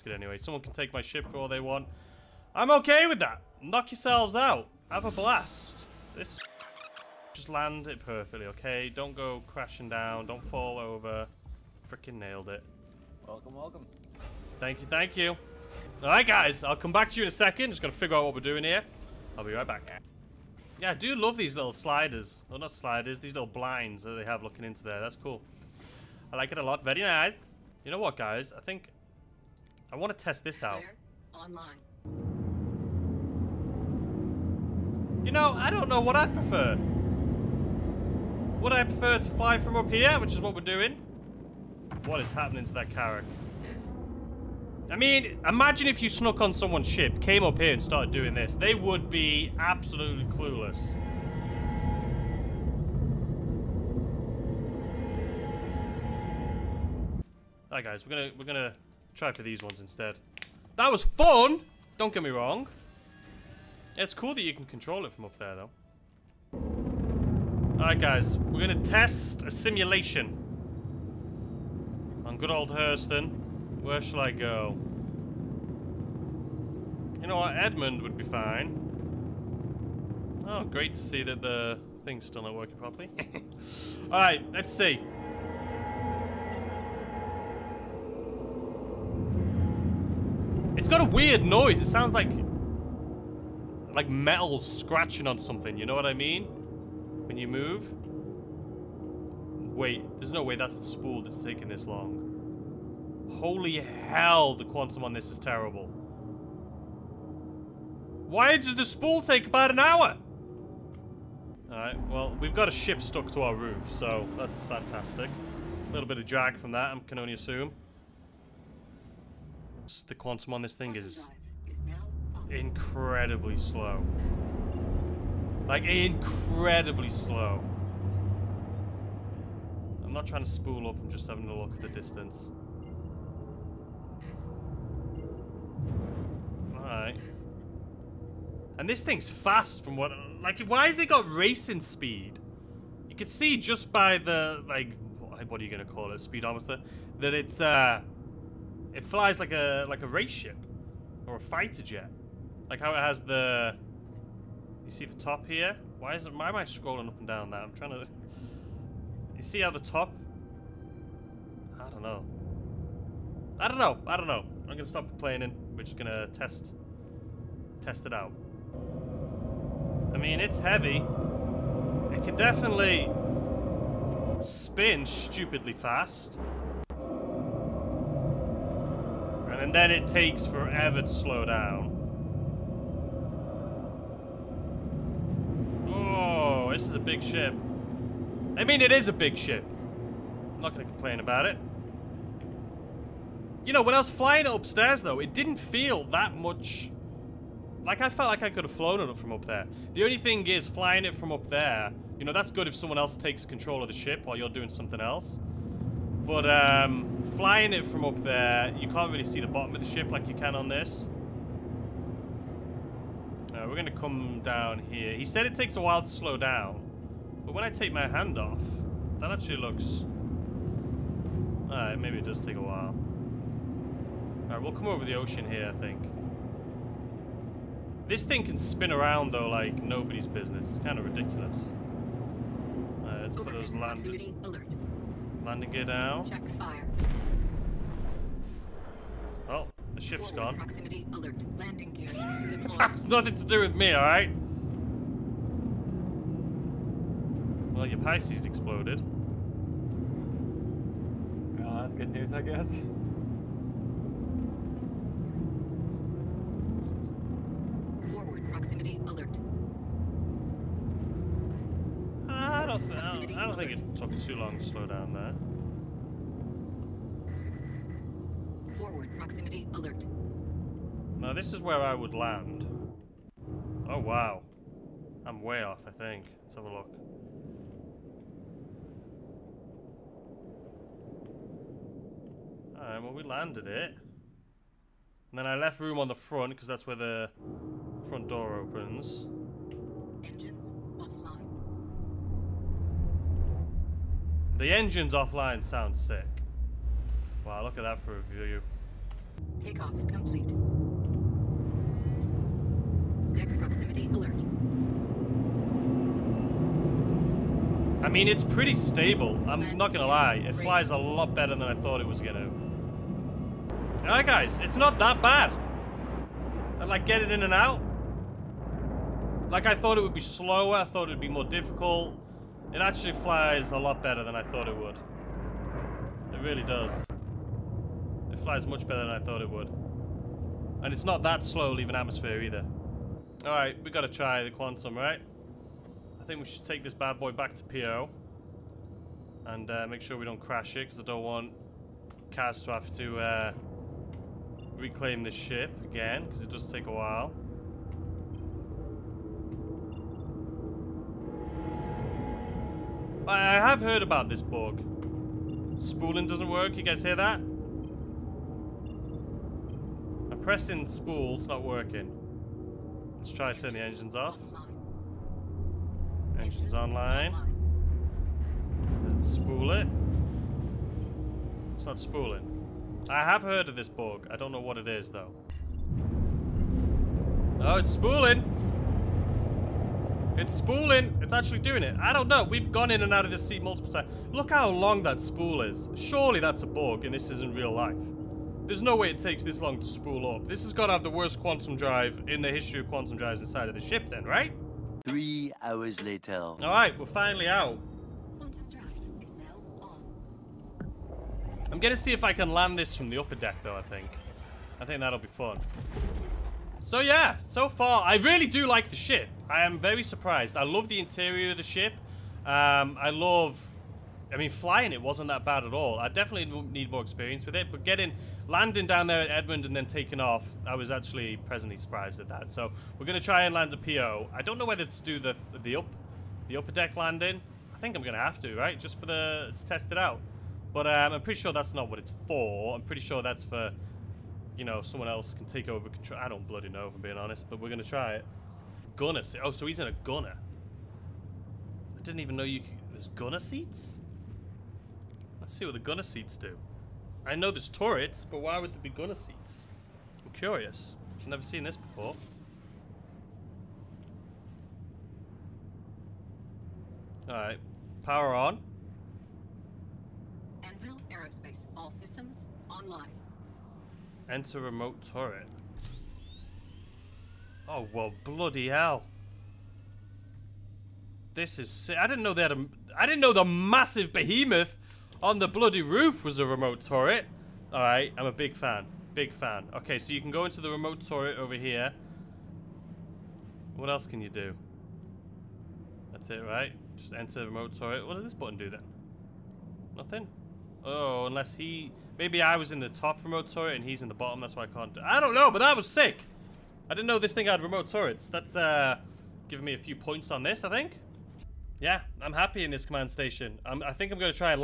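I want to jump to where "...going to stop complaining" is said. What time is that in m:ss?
2:44.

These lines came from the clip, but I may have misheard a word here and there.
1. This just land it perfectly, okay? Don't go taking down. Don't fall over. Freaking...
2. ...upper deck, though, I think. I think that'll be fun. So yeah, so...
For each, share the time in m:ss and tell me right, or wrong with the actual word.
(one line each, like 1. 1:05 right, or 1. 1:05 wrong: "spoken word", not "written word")
1. 0:06 wrong: "crashing", not "taking"
2. 6:43 right.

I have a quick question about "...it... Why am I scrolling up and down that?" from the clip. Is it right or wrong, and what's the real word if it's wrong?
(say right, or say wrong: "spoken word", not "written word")
right.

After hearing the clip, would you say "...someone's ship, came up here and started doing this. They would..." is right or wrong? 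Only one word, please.
right.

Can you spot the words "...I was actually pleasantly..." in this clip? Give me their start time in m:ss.
7:00.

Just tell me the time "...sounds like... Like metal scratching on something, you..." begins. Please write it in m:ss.
1:31.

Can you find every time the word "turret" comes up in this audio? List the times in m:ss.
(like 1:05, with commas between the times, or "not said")
7:27, 7:45, 7:56, 8:01, 8:07, 8:13, 8:17.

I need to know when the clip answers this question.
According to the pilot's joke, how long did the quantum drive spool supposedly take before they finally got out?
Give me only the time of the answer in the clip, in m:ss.
6:35.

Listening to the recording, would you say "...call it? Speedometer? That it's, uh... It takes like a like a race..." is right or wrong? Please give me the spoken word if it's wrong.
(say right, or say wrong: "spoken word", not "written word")
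wrong: "flies", not "takes".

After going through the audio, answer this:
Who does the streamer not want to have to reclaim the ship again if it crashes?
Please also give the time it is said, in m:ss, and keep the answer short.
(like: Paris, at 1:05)
Kaz, at 5:42.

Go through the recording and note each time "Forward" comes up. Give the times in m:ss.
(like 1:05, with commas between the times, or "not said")
4:00, 4:28.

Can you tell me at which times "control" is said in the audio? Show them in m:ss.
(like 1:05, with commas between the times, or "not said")
1:04, 3:23, 7:15.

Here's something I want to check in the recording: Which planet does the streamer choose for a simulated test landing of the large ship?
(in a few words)
Hurston.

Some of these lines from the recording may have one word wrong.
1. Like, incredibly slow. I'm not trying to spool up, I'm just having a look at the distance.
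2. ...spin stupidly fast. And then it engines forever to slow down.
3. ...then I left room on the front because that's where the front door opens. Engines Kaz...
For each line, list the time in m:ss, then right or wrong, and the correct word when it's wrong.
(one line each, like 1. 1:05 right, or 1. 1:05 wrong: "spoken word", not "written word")
1. 2:05 right
2. 2:54 wrong: "takes", not "engines"
3. 4:45 wrong: "The", not "Kaz".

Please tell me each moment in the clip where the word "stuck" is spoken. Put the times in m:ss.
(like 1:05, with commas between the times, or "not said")
1:53.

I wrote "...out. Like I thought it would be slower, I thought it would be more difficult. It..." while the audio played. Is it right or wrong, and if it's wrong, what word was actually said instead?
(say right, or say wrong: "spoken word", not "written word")
right.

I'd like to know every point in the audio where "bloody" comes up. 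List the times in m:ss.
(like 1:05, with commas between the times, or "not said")
7:16, 7:48, 7:55.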